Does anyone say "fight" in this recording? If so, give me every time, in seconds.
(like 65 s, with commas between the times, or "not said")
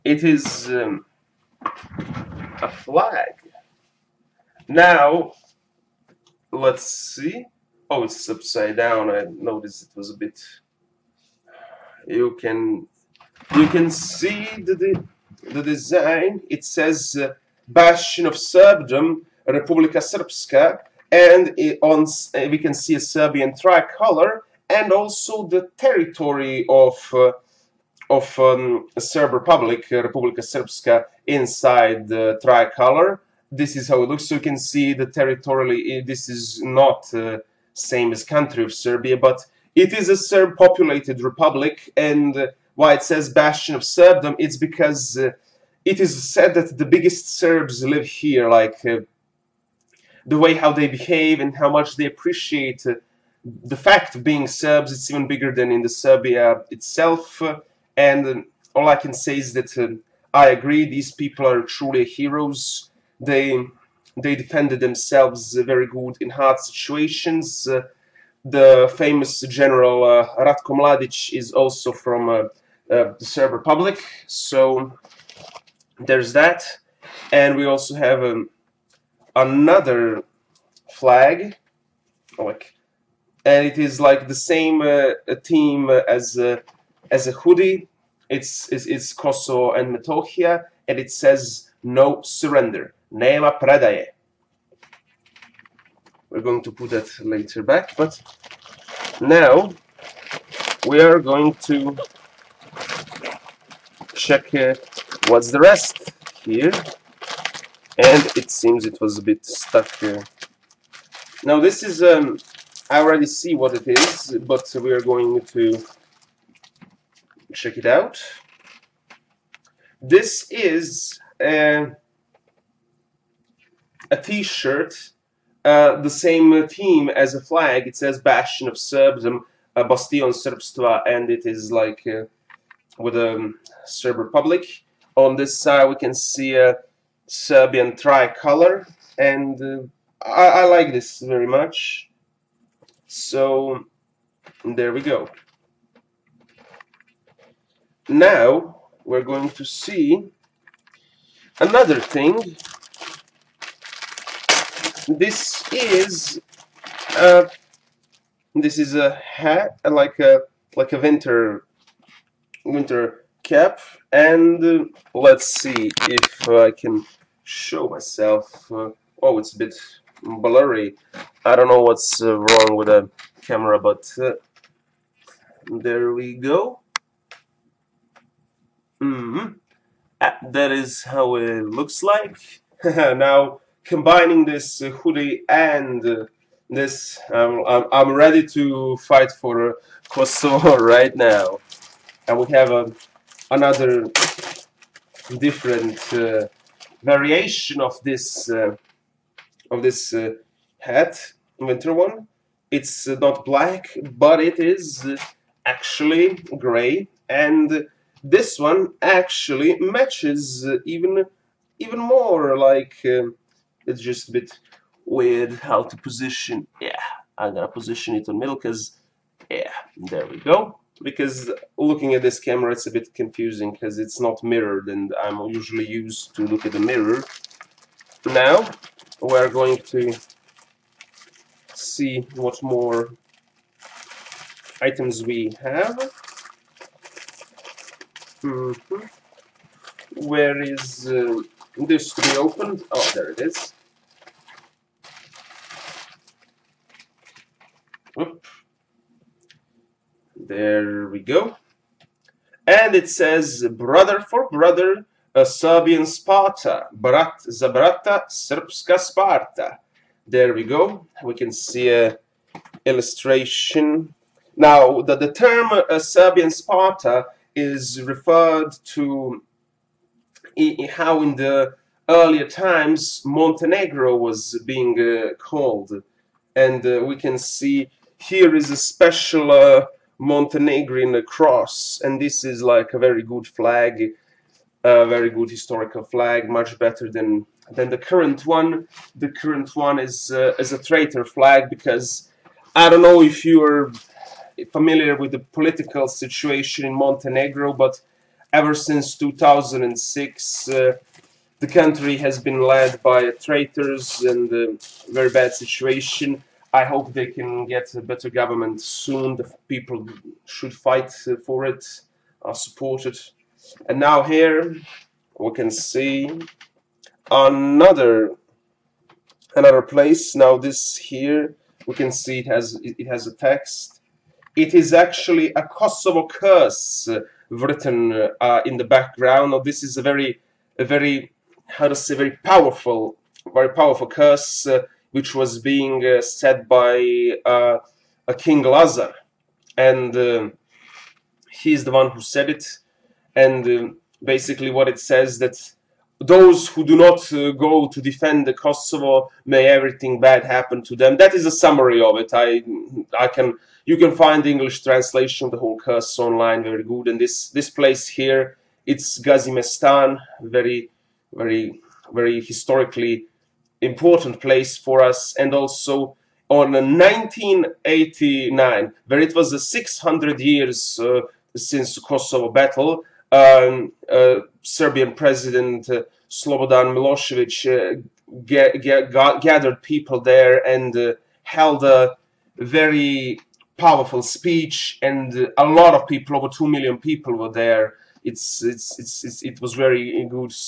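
188 s, 310 s.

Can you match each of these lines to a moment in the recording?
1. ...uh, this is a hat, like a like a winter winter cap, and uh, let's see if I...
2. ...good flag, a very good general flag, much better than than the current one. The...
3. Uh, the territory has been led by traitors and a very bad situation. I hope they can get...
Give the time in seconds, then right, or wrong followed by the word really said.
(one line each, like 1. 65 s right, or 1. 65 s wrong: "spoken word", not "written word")
1. 157 s right
2. 283 s wrong: "historical", not "general"
3. 300 s wrong: "country", not "territory".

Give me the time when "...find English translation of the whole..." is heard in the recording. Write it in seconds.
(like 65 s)
354 s.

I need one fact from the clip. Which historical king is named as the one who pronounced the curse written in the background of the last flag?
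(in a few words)
King Lazar.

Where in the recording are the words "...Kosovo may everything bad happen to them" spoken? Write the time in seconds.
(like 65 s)
348 s.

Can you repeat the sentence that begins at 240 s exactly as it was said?
where is uh, this to be opened oh there it is There we go.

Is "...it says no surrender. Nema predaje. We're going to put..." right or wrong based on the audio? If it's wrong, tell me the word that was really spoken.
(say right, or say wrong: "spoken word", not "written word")
right.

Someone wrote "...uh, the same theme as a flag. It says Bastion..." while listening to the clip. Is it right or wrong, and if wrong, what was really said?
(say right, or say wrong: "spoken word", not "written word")
right.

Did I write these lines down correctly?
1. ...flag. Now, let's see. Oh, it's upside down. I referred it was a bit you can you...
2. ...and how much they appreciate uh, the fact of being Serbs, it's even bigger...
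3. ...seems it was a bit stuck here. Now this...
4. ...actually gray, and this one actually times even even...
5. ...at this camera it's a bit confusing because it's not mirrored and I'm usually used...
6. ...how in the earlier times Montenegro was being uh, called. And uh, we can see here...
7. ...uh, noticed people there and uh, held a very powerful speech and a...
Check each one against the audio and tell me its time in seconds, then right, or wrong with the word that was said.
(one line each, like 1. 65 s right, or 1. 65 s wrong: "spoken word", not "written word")
1. 2 s wrong: "noticed", not "referred"
2. 51 s right
3. 108 s right
4. 205 s wrong: "matches", not "times"
5. 222 s right
6. 270 s right
7. 378 s wrong: "gathered", not "noticed".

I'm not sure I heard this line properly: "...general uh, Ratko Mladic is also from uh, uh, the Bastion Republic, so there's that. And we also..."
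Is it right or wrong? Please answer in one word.
wrong.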